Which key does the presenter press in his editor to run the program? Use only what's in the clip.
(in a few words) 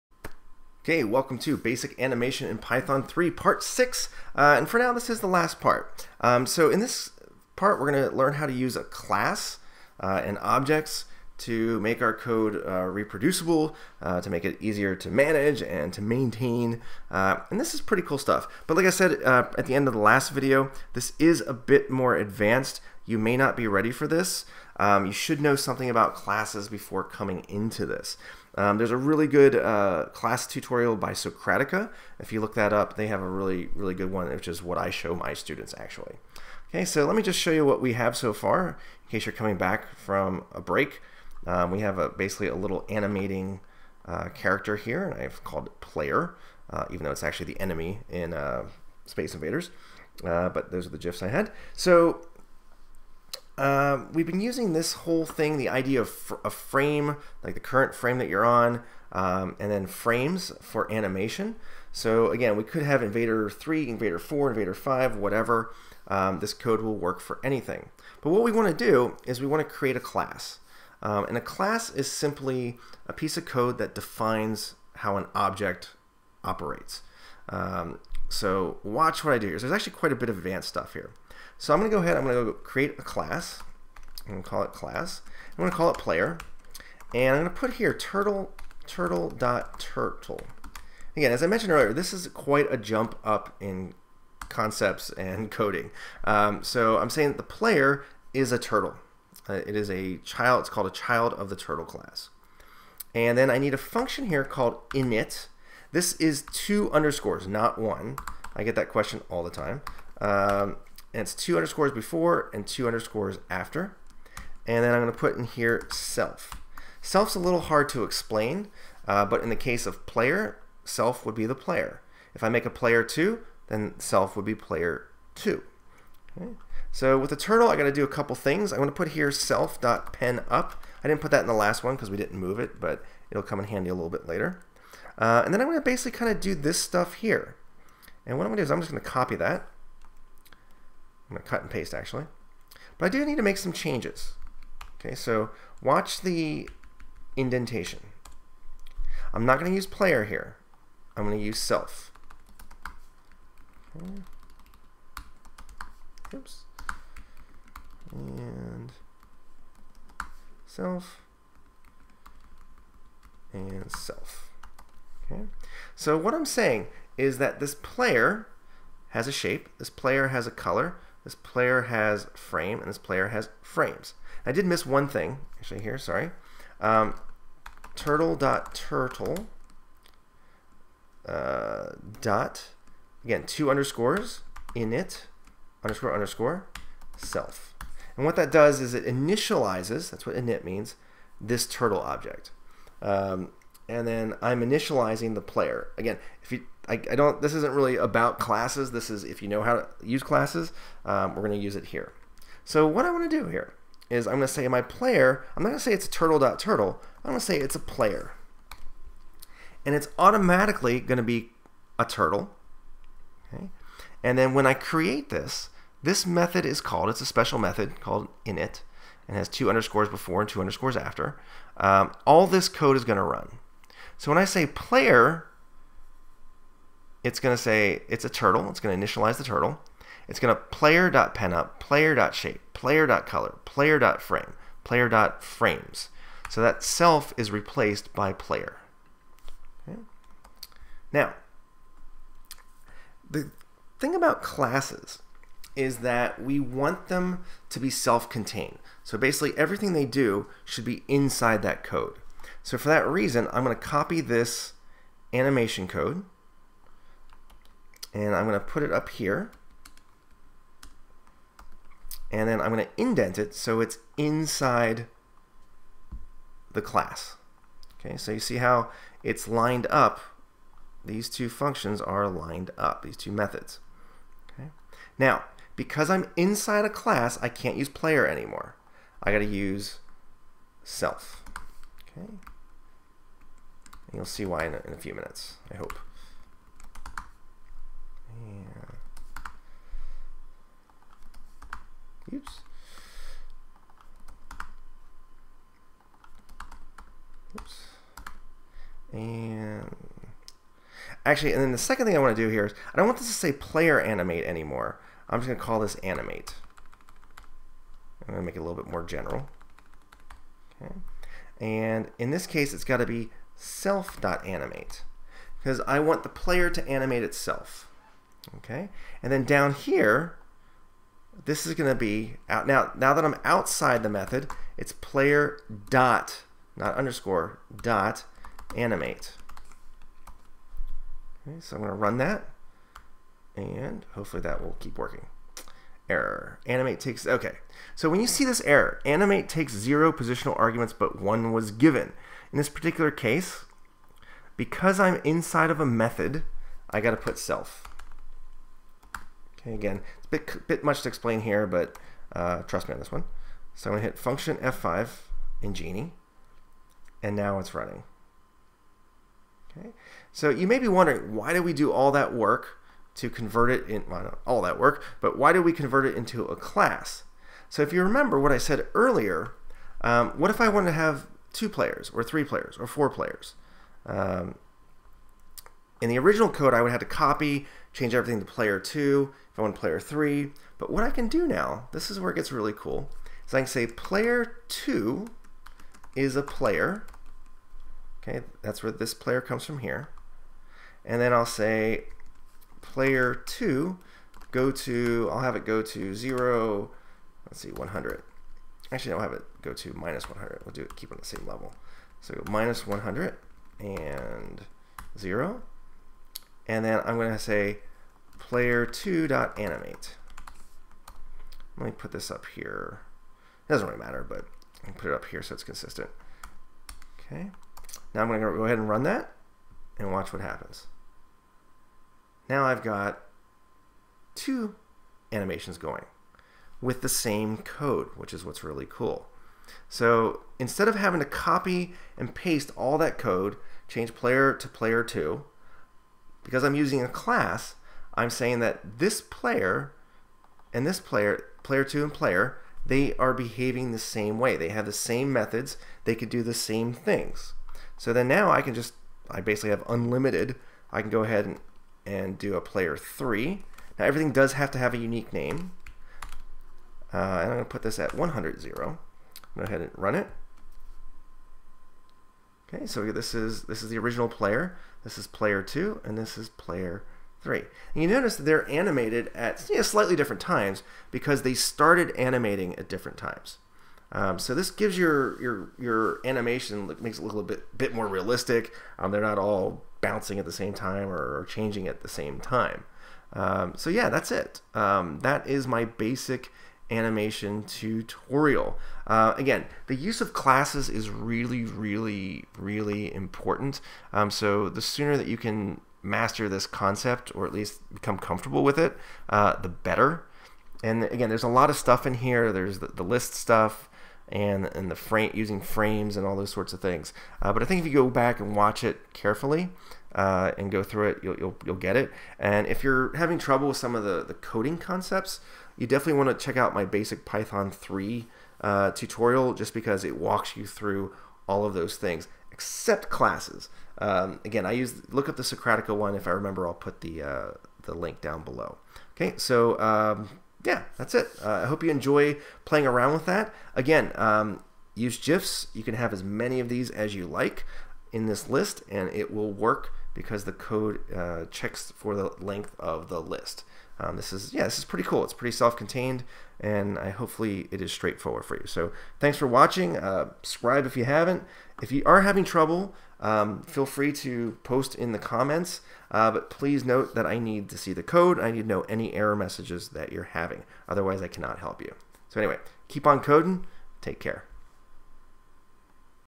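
F5.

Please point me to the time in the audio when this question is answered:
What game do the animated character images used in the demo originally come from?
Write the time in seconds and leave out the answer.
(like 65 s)
49 s.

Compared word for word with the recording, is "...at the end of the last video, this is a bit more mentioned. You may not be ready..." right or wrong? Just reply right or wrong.
wrong.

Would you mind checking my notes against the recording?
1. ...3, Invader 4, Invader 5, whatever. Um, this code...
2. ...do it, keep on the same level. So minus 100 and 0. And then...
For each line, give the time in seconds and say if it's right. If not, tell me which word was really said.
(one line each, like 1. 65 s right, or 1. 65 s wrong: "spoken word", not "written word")
1. 63 s right
2. 400 s right.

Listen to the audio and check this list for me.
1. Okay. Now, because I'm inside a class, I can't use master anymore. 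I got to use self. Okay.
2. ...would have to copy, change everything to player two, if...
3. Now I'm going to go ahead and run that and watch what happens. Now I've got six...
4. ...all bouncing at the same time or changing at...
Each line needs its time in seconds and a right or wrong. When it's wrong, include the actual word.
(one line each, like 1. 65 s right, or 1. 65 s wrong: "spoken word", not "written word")
1. 274 s wrong: "player", not "master"
2. 376 s right
3. 418 s wrong: "two", not "six"
4. 479 s right.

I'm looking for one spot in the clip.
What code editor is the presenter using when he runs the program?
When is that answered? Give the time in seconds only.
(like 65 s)
355 s.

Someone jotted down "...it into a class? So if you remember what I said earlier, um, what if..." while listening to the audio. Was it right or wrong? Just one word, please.
right.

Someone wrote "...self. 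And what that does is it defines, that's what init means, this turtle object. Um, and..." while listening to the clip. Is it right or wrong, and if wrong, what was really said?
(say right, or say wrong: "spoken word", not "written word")
wrong: "initializes", not "defines".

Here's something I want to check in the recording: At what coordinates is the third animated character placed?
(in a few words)
100, 0.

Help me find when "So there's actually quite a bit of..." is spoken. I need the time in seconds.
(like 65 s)
79 s.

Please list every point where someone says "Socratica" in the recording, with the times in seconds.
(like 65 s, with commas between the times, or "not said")
31 s, 525 s.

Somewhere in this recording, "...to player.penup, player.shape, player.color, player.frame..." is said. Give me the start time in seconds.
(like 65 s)
230 s.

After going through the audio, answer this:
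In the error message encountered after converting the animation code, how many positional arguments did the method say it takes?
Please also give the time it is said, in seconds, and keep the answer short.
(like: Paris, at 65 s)
0, at 339 s.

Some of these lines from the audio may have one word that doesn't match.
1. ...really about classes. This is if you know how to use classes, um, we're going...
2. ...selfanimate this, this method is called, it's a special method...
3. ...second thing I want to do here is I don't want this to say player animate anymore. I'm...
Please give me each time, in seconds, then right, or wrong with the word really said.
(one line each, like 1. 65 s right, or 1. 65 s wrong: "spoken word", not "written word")
1. 197 s right
2. 214 s wrong: "create", not "selfanimate"
3. 301 s right.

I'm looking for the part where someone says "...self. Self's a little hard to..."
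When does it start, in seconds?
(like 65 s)
115 s.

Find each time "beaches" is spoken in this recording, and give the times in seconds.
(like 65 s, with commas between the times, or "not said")
not said.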